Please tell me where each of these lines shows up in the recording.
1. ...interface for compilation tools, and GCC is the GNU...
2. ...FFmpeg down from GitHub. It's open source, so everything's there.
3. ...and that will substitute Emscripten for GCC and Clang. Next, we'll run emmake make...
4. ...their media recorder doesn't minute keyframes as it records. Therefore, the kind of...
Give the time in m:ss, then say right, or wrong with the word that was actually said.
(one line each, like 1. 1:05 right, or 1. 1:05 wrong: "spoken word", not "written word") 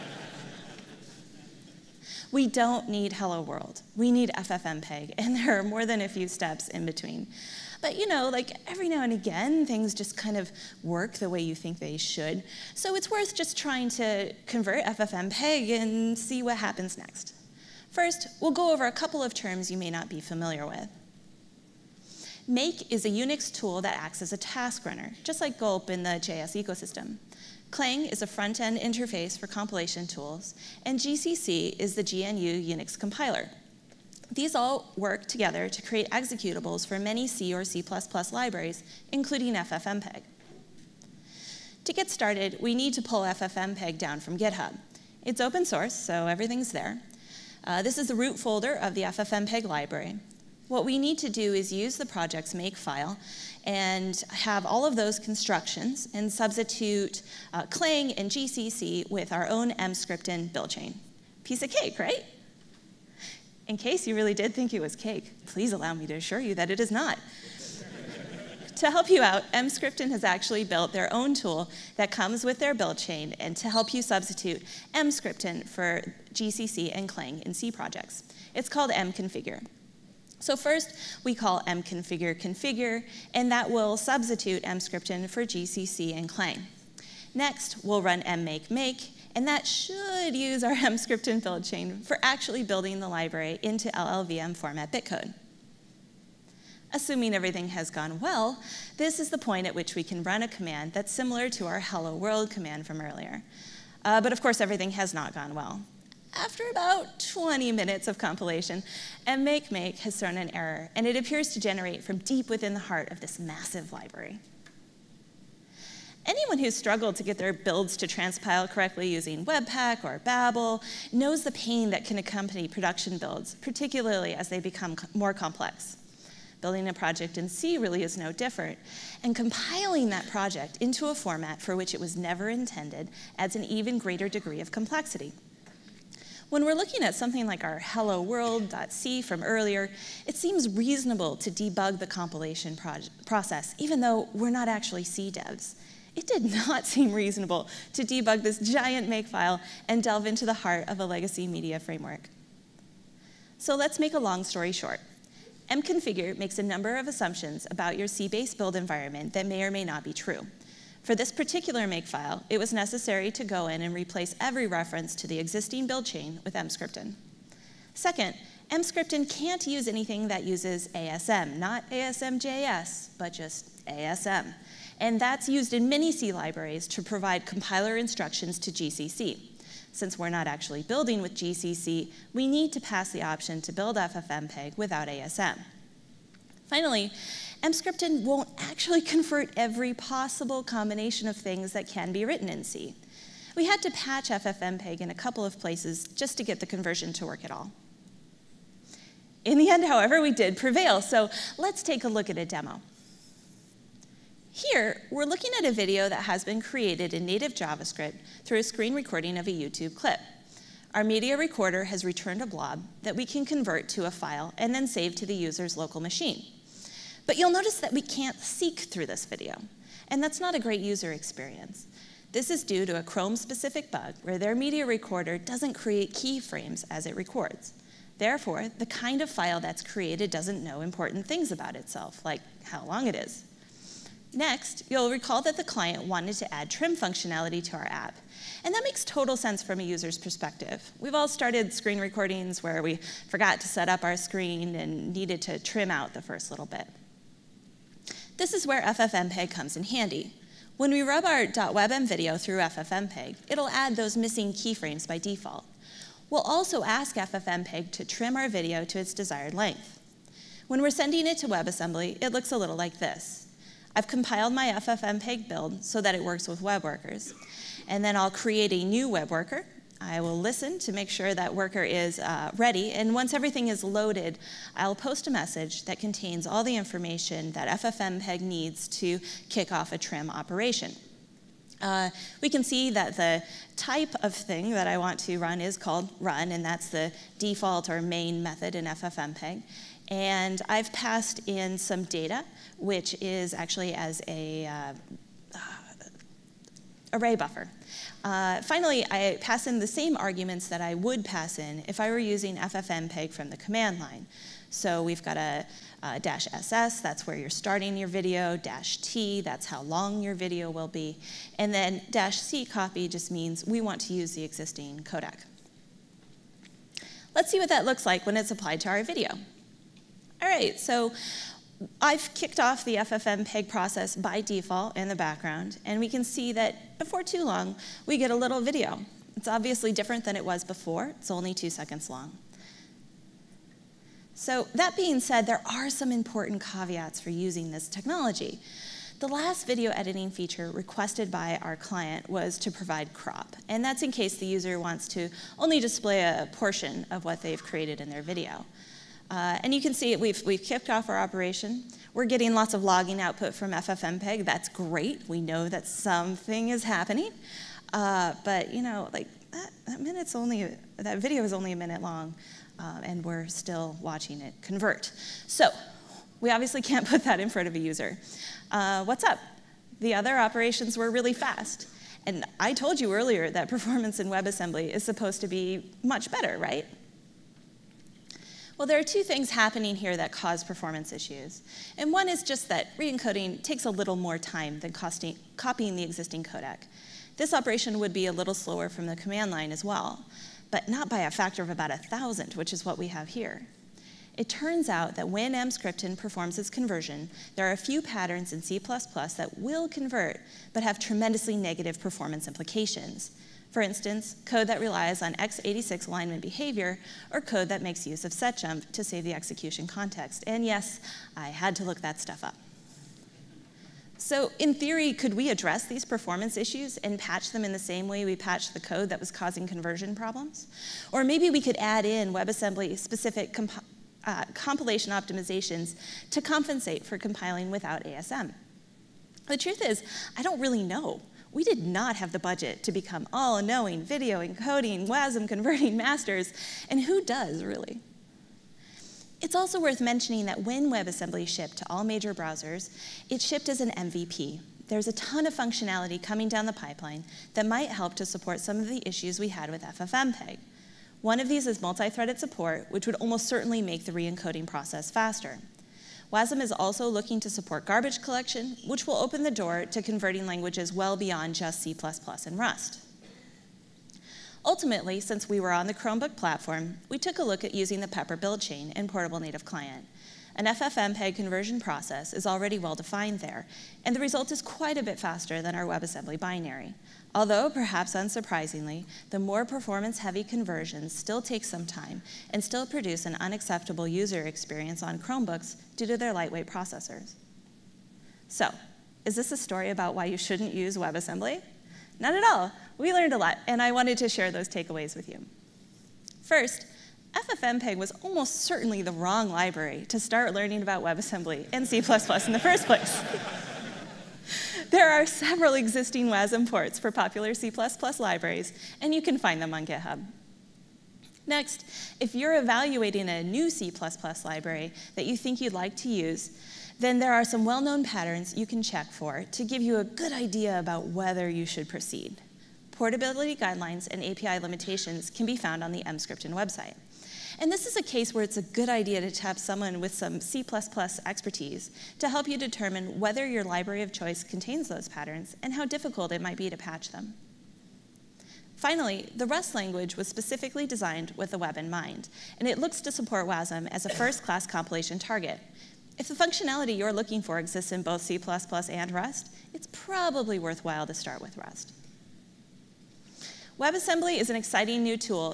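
1. 0:28 right
2. 0:43 right
3. 1:23 right
4. 3:44 wrong: "create", not "minute".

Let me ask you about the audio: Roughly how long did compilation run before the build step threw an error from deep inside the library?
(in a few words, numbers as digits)
20 minutes.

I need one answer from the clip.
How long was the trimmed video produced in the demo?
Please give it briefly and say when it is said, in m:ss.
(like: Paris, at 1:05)
2 seconds, at 5:31.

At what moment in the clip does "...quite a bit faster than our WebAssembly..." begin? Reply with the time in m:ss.
7:54.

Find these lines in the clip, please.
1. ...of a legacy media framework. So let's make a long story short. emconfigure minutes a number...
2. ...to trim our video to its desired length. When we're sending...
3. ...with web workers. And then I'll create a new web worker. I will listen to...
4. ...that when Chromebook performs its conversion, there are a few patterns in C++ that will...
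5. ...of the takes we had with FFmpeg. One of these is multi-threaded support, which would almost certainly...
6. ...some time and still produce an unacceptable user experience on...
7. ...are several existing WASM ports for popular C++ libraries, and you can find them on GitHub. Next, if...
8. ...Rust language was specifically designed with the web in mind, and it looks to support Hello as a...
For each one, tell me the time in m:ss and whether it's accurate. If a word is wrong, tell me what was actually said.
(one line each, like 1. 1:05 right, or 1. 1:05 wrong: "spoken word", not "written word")
1. 2:30 wrong: "makes", not "minutes"
2. 4:17 right
3. 4:26 right
4. 6:35 wrong: "Emscripten", not "Chromebook"
5. 7:28 wrong: "issues", not "takes"
6. 8:01 right
7. 8:25 right
8. 8:59 wrong: "WASM", not "Hello".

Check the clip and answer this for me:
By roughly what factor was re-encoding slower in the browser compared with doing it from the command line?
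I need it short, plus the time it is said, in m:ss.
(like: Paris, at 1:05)
1,000, at 6:31.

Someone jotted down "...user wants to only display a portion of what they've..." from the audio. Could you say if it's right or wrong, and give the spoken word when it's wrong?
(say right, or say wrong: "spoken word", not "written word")
right.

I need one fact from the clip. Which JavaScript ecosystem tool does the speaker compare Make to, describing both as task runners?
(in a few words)
gulp.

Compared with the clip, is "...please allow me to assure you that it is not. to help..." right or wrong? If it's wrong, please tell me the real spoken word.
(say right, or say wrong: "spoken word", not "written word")
right.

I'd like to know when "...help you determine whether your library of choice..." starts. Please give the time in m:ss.
8:52.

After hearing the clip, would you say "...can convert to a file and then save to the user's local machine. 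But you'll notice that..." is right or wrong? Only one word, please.
right.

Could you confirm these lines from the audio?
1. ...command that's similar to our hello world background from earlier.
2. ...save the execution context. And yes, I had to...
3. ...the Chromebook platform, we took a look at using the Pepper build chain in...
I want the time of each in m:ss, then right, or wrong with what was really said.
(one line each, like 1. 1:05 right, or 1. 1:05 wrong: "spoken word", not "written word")
1. 1:40 wrong: "command", not "background"
2. 6:49 right
3. 7:45 right.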